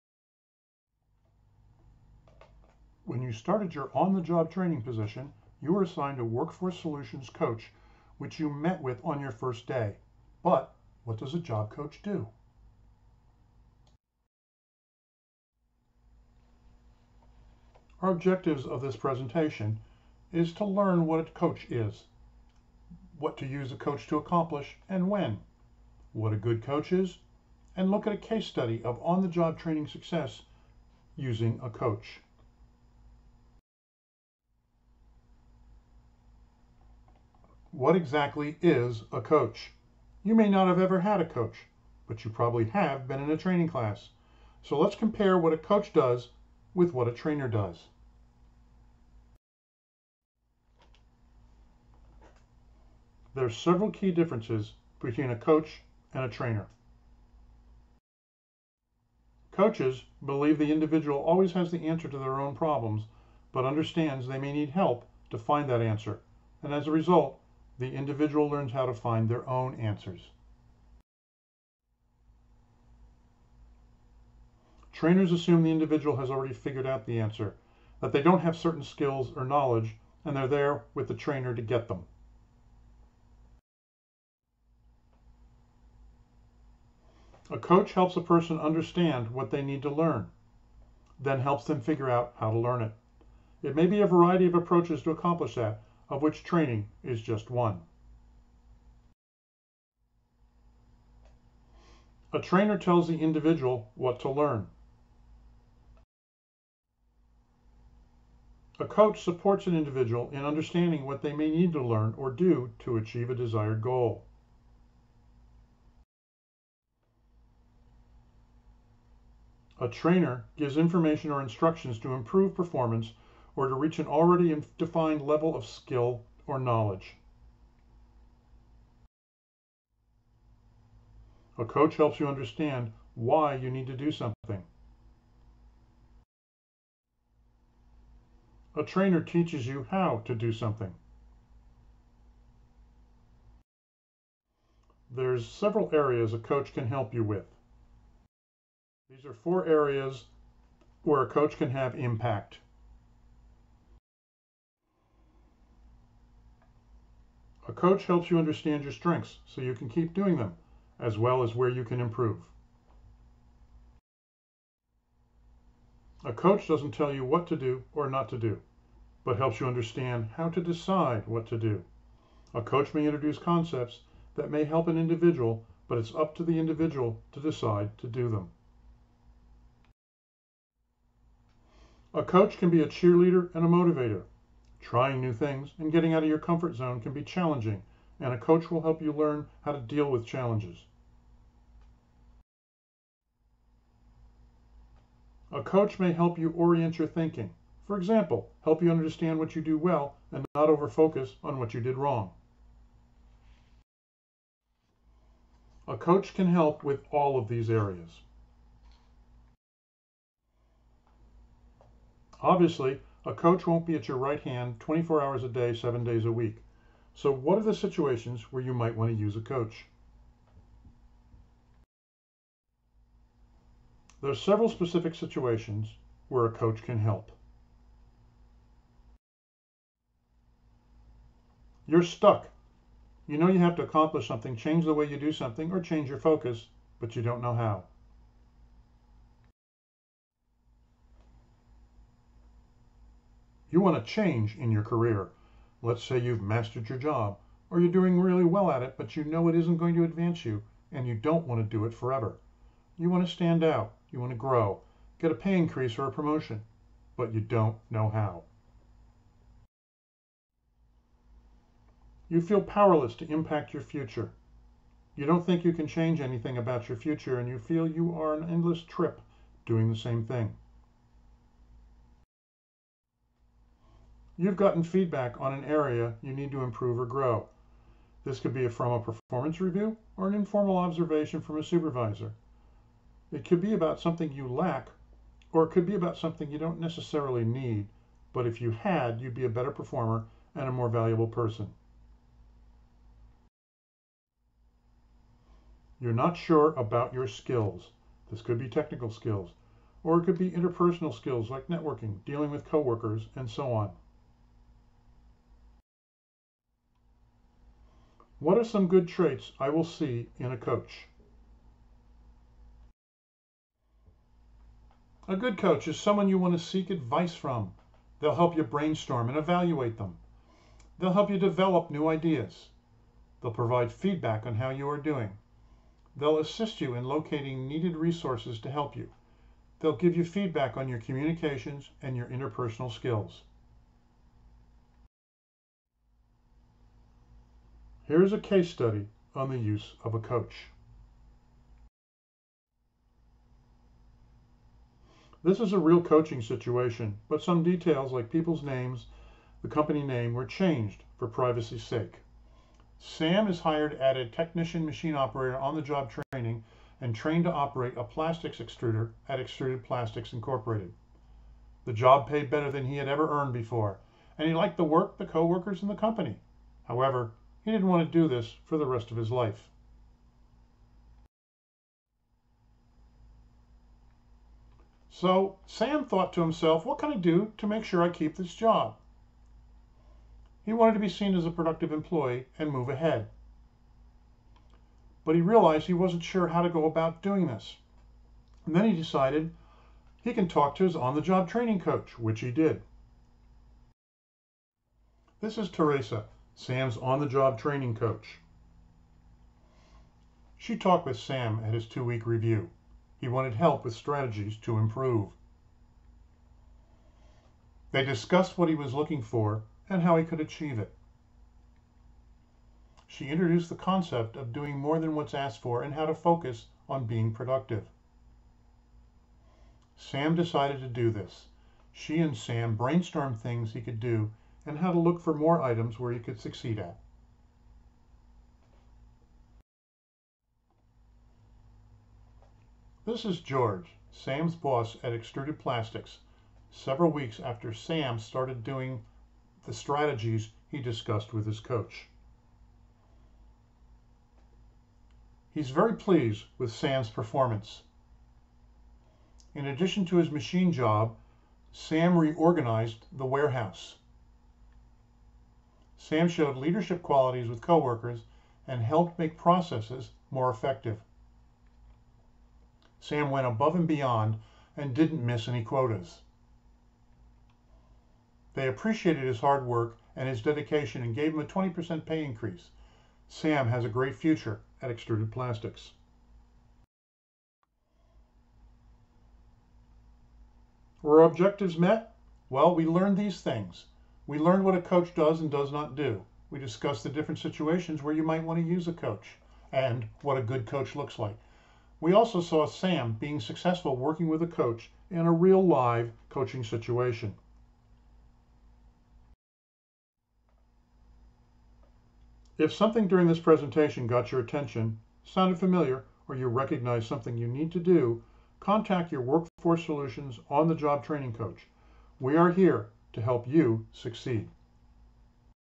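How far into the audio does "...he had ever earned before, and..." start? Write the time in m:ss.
6:02.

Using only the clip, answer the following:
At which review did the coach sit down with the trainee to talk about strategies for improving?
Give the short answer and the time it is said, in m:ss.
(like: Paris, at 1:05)
two week review, at 6:41.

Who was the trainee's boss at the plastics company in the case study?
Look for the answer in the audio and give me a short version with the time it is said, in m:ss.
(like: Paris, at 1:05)
George, at 7:13.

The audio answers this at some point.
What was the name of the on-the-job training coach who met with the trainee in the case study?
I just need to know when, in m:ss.
6:35.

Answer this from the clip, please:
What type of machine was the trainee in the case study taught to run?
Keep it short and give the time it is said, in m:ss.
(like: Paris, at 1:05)
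plastics extruder, at 5:58.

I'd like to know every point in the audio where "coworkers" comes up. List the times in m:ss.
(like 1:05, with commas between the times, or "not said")
5:02, 6:05, 7:37.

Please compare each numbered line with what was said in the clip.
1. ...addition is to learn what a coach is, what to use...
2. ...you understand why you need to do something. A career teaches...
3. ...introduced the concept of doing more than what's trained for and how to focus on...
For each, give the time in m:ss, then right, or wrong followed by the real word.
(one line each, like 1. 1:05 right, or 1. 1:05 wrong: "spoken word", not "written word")
1. 0:18 wrong: "presentation", not "addition"
2. 2:12 wrong: "trainer", not "career"
3. 6:53 wrong: "asked", not "trained".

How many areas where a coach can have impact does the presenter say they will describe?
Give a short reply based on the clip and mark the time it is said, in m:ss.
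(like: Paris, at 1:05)
4, at 2:29.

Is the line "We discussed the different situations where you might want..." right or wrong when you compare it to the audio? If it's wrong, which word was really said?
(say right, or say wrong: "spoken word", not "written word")
right.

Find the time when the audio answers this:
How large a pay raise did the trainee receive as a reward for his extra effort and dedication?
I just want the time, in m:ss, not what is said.
7:51.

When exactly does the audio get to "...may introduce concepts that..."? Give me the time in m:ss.
2:52.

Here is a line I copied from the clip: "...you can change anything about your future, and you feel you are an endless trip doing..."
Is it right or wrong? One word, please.
right.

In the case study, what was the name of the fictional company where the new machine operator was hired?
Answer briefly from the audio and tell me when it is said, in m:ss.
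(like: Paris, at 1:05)
Extruded Plastics Incorporated, at 5:59.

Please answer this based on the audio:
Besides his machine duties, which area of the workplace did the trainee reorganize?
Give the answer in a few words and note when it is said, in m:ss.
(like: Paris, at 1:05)
the warehouse, at 7:33.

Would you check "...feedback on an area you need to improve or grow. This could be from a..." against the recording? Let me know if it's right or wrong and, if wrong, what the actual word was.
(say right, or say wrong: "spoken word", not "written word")
right.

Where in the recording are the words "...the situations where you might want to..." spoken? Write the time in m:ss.
3:37.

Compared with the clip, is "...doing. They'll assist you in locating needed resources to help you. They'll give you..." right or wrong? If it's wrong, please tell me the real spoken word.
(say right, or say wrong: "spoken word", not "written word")
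right.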